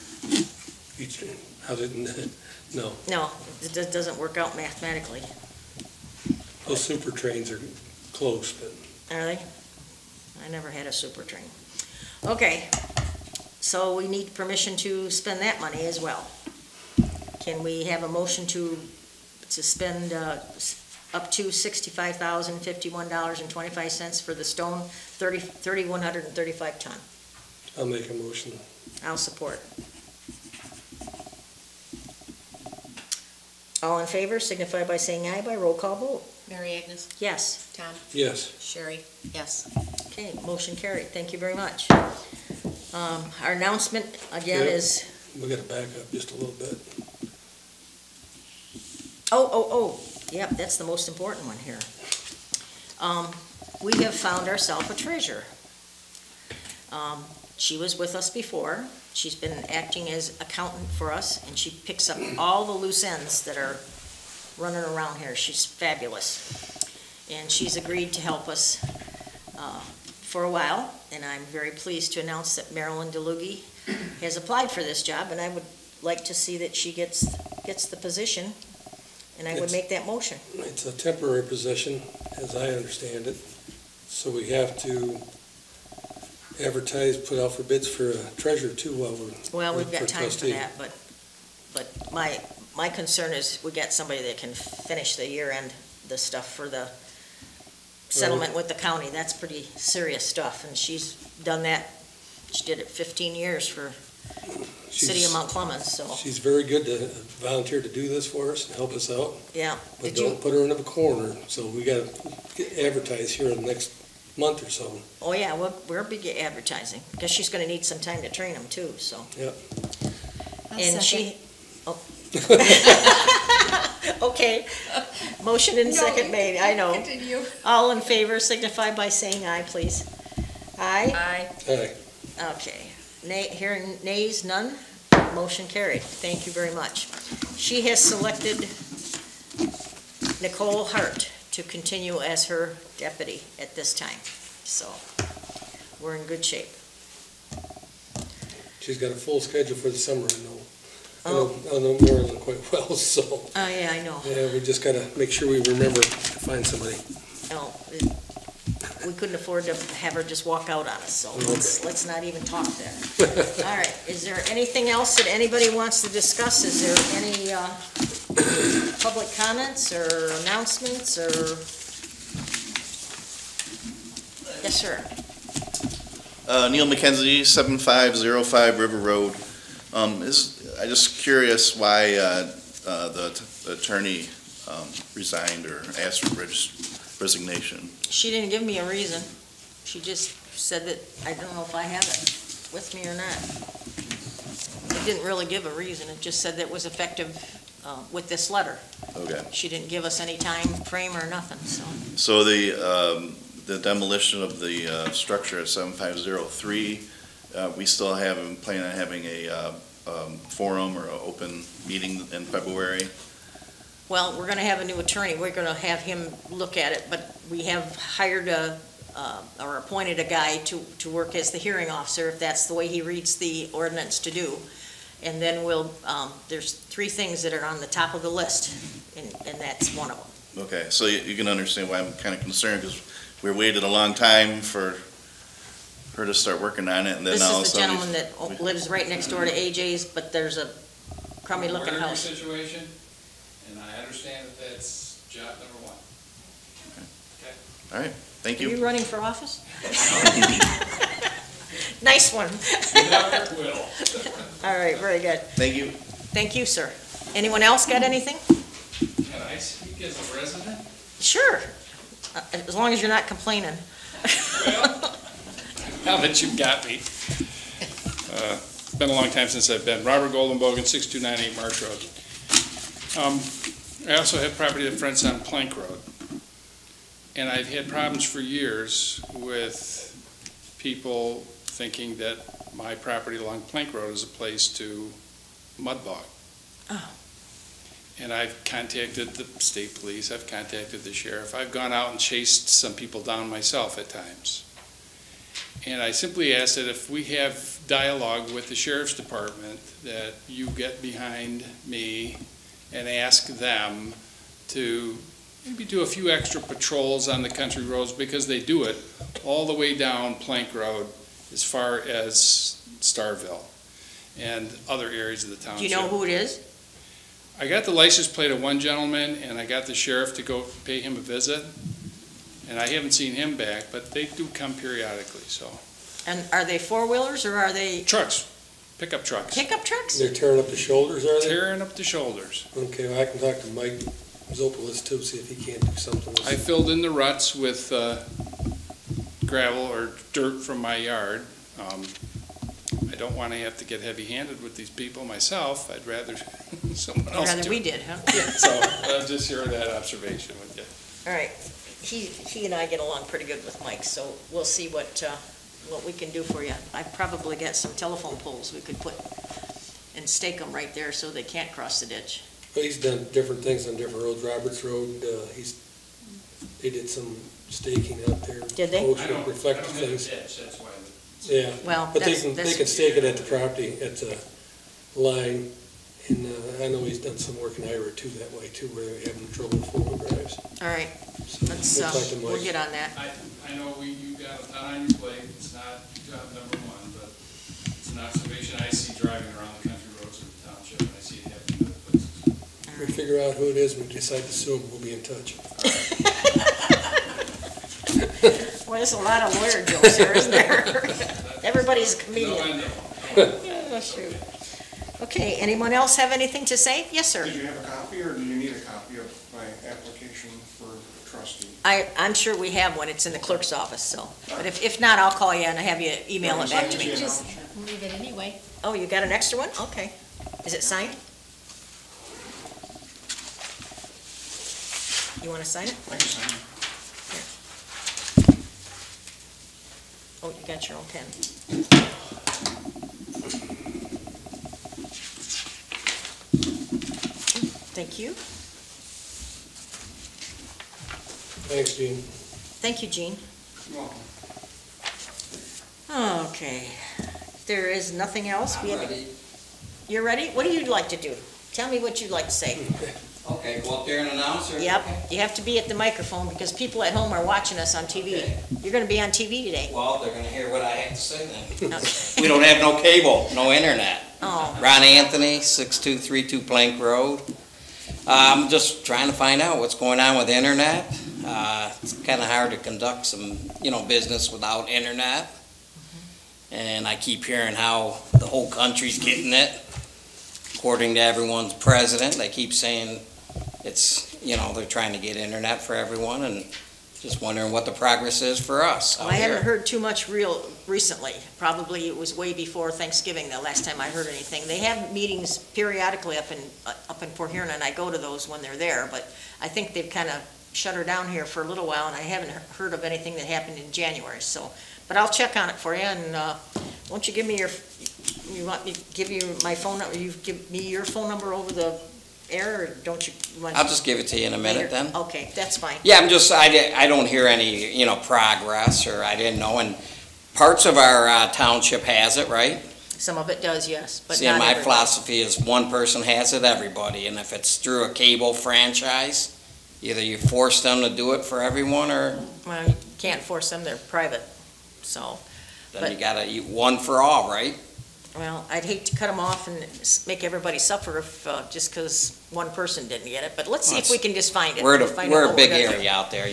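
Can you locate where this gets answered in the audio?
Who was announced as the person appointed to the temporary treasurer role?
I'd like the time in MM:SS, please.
01:12.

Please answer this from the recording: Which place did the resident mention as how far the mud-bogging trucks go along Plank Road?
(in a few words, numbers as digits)
Starville.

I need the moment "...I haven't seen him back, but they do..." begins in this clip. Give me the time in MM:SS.
05:22.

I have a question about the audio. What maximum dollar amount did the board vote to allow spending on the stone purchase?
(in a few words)
$65,051.25.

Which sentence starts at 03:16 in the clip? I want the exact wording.
It just said that it was effective uh, with this letter.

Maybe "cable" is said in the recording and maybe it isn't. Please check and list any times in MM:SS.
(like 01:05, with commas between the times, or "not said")
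07:43, 08:48.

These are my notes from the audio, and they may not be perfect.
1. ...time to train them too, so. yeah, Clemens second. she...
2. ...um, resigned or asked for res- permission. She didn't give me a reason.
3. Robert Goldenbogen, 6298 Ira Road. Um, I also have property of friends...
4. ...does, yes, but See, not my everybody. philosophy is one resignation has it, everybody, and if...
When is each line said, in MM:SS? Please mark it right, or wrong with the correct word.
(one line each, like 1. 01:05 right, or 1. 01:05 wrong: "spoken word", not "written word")
1. 01:58 wrong: "And", not "Clemens"
2. 03:04 wrong: "resignation", not "permission"
3. 04:30 wrong: "Marsh", not "Ira"
4. 08:43 wrong: "person", not "resignation".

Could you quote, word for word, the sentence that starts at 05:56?
i probably got some telephone poles we could put and stake them right there so they can't cross the ditch.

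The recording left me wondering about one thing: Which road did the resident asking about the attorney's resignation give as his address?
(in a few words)
River Road.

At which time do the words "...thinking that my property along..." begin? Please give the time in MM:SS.
04:41.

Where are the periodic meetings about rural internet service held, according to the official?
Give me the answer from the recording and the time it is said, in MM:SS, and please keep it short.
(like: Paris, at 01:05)
Port Huron, at 08:17.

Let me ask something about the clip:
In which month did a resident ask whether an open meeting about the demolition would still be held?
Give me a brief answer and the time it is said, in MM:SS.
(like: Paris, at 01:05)
February, at 03:32.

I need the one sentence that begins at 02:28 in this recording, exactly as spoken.
She's got a full schedule for the summer, I know.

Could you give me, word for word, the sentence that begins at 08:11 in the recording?
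Probably it was way before Thanksgiving the last time I heard anything.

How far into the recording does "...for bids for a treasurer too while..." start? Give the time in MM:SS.
01:27.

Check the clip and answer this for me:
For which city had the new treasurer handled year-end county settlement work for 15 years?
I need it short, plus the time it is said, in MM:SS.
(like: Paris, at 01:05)
Mount Clemens, at 01:44.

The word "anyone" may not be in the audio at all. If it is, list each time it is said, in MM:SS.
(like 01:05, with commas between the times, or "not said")
04:17, 06:45.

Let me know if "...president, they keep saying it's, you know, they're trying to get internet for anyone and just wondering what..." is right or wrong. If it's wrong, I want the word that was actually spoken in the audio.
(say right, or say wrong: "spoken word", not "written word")
wrong: "everyone", not "anyone".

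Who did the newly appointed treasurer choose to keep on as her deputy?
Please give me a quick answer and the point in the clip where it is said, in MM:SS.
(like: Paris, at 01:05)
Nicole Hart, at 02:20.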